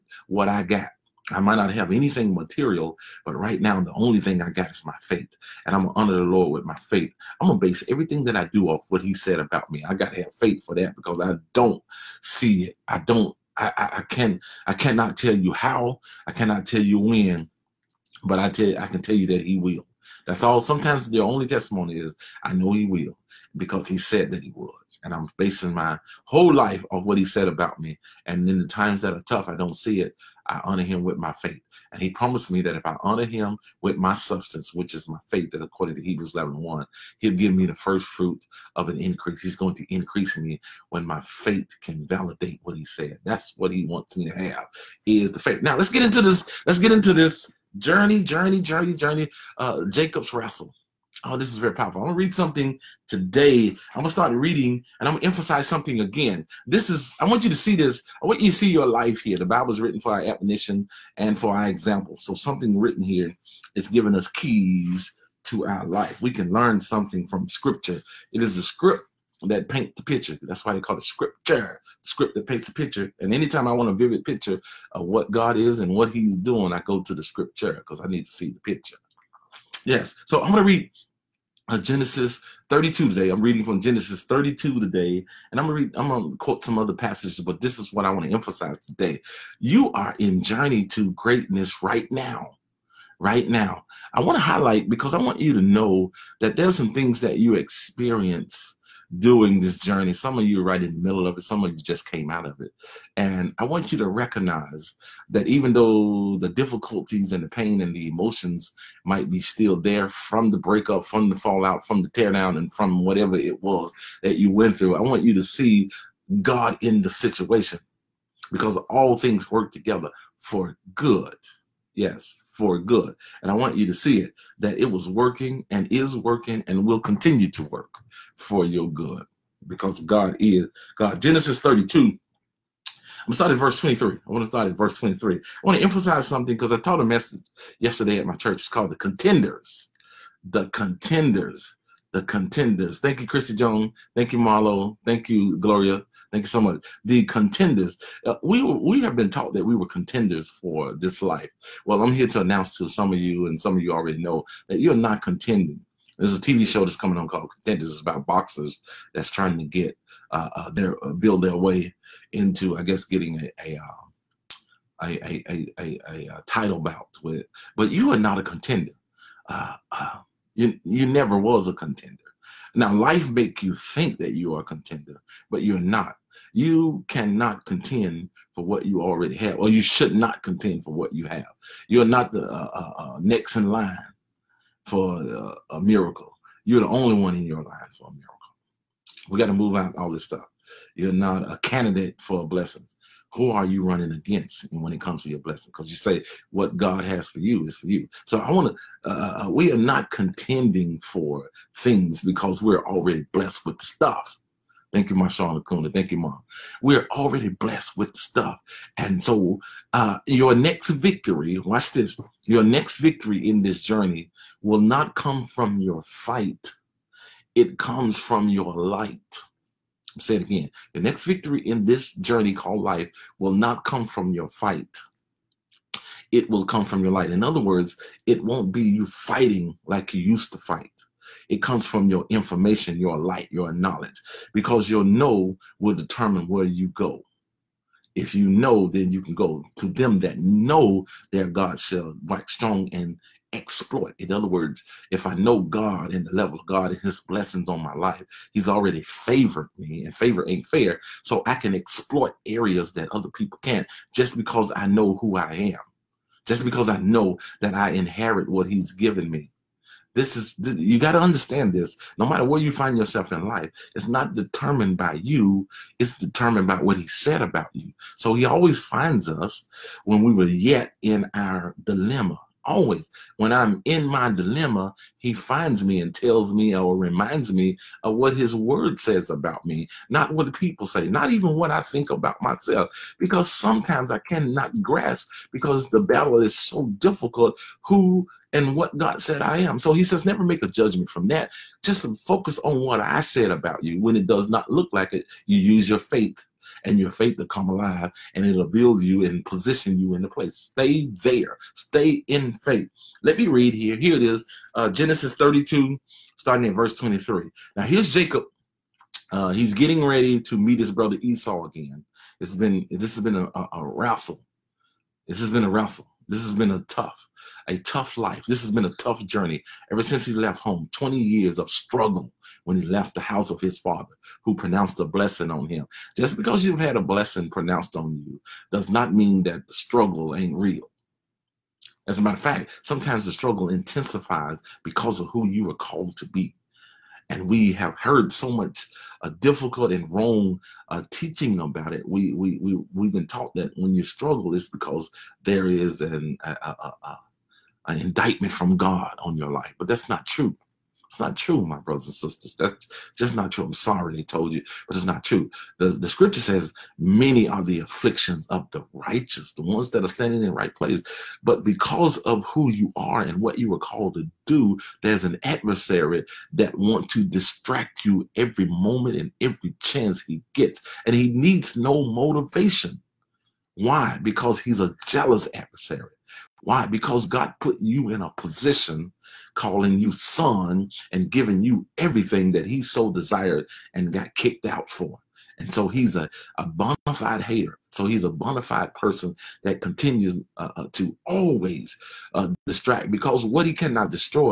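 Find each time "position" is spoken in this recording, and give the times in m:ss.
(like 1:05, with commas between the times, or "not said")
4:59, 6:18.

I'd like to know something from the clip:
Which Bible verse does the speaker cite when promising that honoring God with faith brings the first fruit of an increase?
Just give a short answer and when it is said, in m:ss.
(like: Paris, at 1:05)
Hebrews 11:1, at 0:36.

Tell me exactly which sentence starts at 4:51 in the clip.
Just focus on what I said about you.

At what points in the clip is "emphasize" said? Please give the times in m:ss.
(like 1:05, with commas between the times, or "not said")
0:55, 1:28, 2:15.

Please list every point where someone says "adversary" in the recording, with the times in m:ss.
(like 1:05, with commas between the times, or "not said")
6:05, 6:15.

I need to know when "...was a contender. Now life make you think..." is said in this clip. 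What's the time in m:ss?
2:51.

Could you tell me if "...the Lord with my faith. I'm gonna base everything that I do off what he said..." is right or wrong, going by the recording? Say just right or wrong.
right.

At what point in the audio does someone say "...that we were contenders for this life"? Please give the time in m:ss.
2:29.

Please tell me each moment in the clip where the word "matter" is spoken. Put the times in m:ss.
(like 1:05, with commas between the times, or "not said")
4:22, 5:32.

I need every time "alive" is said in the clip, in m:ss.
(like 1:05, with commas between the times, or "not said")
4:57.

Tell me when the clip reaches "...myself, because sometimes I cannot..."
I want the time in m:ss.
4:42.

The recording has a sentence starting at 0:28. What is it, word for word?
And in the times that are tough, I don't see it.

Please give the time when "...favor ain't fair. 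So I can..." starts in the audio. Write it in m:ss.
4:10.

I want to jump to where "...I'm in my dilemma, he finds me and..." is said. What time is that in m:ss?
4:33.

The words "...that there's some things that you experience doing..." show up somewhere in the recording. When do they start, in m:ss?
1:36.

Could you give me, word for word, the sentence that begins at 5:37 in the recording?
And we have heard so much uh, difficult and wrong uh, teaching about it.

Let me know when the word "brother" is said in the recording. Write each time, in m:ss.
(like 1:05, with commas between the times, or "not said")
5:10, 5:51.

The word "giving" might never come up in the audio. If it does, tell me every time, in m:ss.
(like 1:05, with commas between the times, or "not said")
1:03, 6:21.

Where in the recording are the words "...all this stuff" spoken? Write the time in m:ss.
3:09.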